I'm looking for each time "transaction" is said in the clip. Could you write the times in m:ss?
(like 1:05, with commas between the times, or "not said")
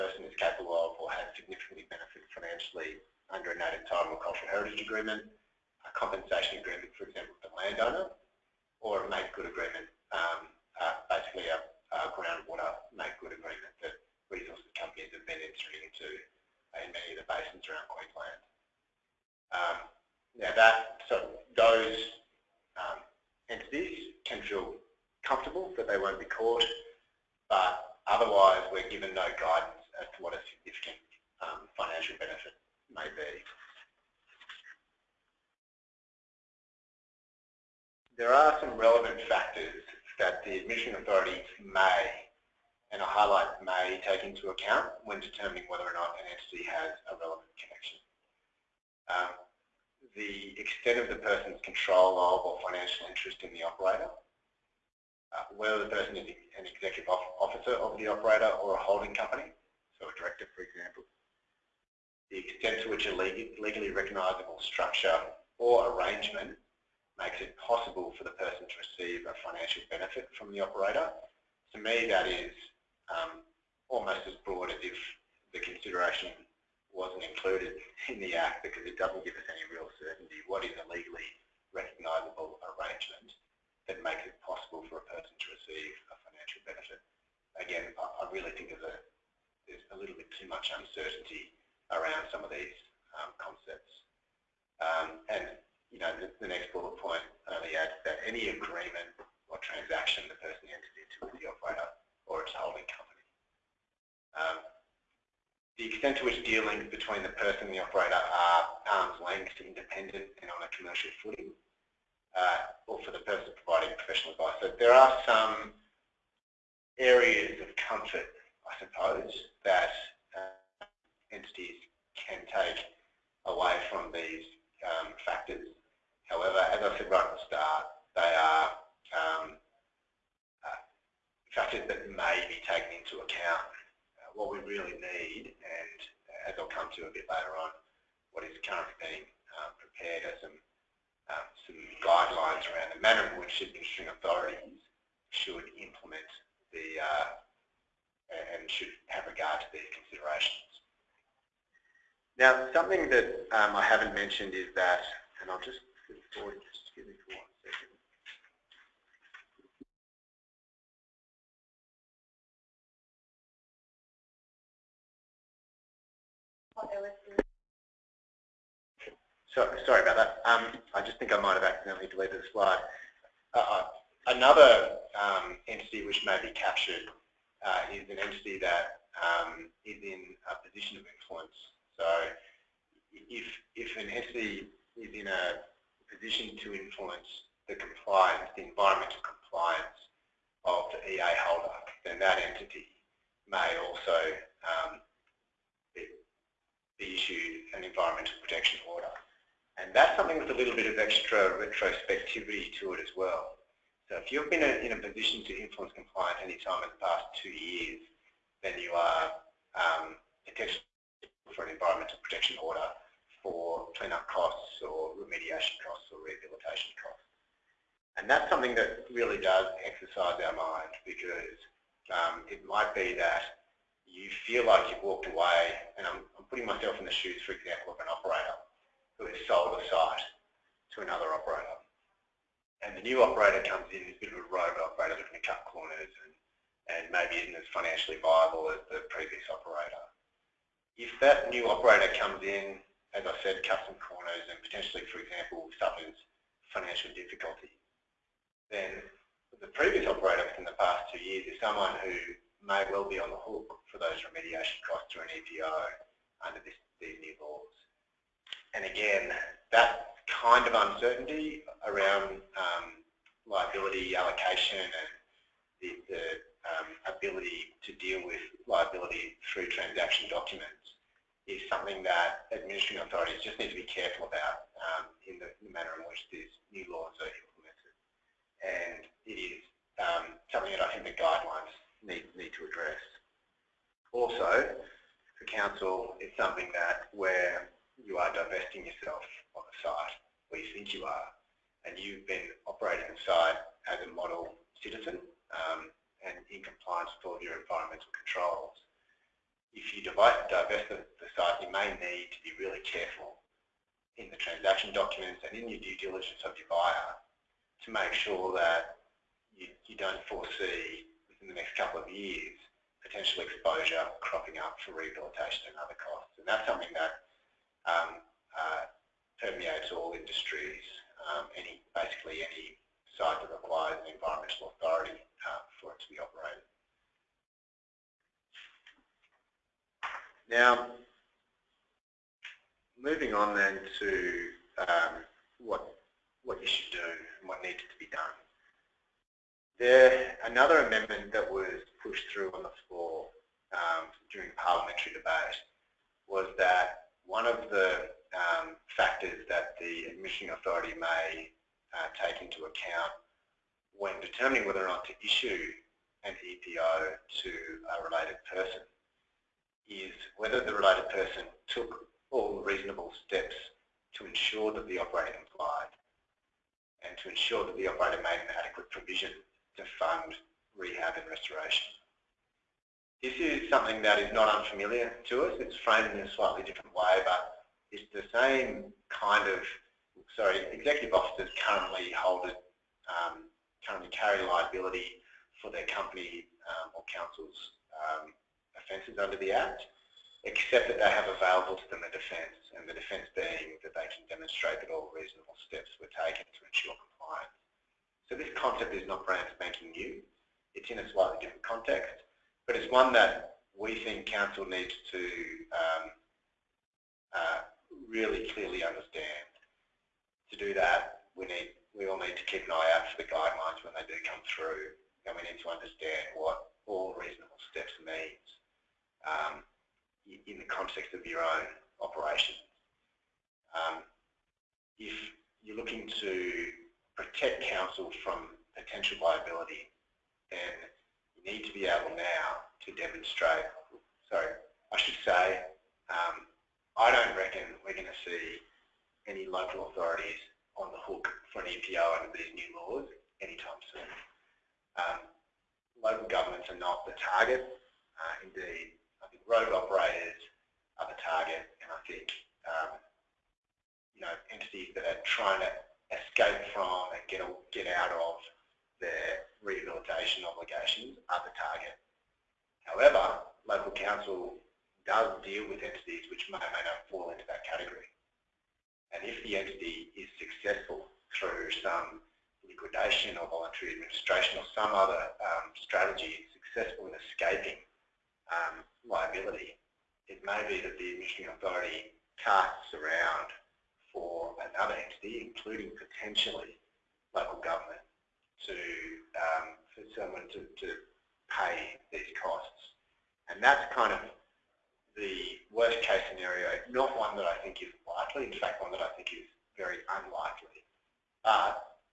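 1:39, 4:29, 5:04.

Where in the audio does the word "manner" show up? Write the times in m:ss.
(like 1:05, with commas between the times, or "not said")
2:23, 4:35.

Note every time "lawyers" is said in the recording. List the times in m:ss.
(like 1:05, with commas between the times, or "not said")
not said.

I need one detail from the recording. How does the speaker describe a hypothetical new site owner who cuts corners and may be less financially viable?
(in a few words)
a rogue operator.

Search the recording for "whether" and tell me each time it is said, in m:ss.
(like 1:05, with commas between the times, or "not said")
0:45, 0:55, 5:54, 6:00.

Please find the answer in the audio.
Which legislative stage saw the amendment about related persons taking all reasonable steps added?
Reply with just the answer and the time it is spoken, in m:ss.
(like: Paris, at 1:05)
parliamentary debate, at 5:44.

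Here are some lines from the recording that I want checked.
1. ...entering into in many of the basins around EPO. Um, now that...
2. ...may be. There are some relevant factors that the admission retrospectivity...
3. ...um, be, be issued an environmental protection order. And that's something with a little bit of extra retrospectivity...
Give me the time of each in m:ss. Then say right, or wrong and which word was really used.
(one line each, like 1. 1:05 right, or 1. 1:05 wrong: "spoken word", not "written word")
1. 0:15 wrong: "Queensland", not "EPO"
2. 0:32 wrong: "authority", not "retrospectivity"
3. 3:14 right.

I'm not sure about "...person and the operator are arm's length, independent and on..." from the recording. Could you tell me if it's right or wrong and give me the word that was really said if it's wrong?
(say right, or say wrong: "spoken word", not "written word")
right.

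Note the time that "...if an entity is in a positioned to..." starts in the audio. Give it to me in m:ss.
3:03.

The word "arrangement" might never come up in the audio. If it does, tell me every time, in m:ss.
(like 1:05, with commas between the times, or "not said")
1:05, 1:22.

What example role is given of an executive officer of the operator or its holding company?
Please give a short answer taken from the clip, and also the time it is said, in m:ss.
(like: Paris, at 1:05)
director, at 1:00.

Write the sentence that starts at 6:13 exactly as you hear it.
This is something that is not unfamiliar to us.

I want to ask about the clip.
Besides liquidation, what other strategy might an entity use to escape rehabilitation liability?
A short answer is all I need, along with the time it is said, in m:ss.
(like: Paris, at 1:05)
voluntary administration, at 7:53.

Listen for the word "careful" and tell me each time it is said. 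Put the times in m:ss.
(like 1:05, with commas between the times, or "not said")
4:33, 5:02.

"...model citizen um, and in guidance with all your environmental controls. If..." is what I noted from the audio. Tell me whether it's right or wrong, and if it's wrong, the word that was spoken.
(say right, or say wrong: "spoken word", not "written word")
wrong: "compliance", not "guidance".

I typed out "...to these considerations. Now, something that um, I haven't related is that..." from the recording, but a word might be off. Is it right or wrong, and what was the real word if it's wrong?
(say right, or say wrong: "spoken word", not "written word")
wrong: "mentioned", not "related".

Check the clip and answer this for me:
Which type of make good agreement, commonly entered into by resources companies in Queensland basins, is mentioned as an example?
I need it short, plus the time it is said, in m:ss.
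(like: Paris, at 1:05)
groundwater, at 0:12.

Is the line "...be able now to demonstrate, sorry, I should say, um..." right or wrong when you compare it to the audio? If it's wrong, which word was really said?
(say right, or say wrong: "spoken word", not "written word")
right.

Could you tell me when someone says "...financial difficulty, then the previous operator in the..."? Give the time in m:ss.
4:06.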